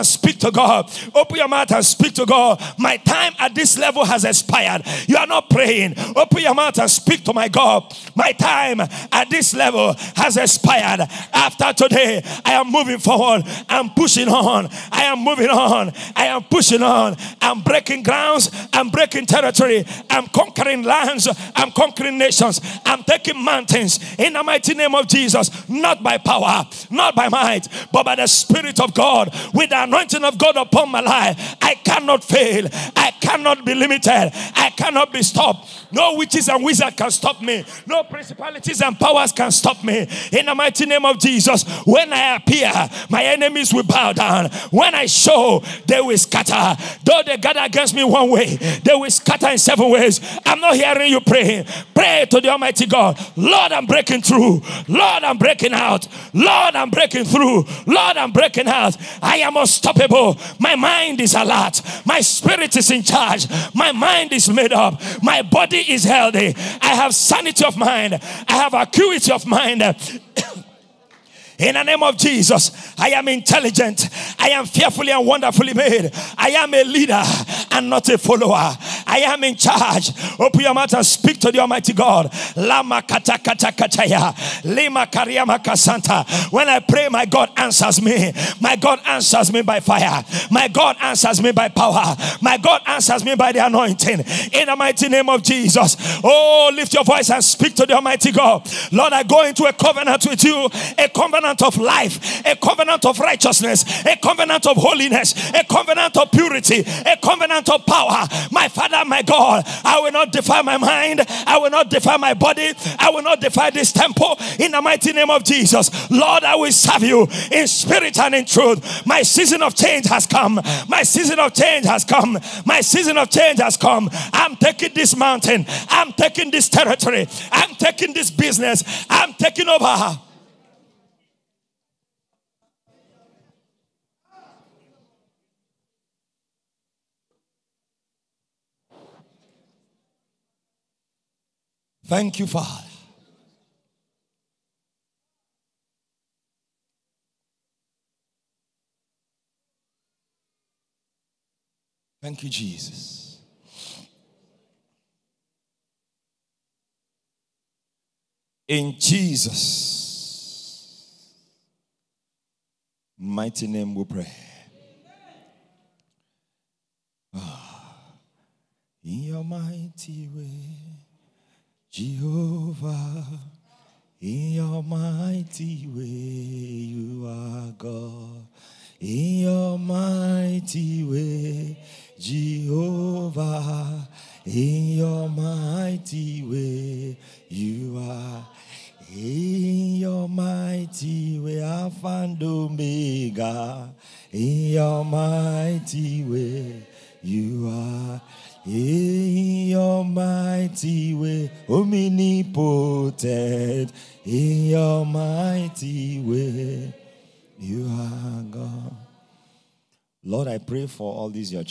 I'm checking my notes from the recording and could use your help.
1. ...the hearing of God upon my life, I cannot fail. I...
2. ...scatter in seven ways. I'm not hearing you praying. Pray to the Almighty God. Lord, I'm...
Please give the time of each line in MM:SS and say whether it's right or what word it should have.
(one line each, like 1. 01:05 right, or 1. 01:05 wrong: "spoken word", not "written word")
1. 00:29 wrong: "anointing", not "hearing"
2. 00:49 right.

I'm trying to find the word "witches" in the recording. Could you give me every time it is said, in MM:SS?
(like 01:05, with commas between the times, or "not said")
00:36.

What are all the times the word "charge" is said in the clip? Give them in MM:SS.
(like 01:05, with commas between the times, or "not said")
01:03, 01:19.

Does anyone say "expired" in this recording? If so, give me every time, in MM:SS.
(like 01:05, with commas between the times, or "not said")
00:04, 00:10.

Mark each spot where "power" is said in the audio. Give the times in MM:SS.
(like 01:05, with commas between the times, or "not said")
00:26, 00:38, 01:31, 01:47.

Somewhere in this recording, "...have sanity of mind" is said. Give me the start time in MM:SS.
01:06.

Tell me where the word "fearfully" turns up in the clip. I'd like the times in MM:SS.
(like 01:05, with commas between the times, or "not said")
01:14.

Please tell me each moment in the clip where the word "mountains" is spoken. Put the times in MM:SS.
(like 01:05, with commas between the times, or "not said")
00:23, 02:05.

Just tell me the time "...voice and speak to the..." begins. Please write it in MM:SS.
01:37.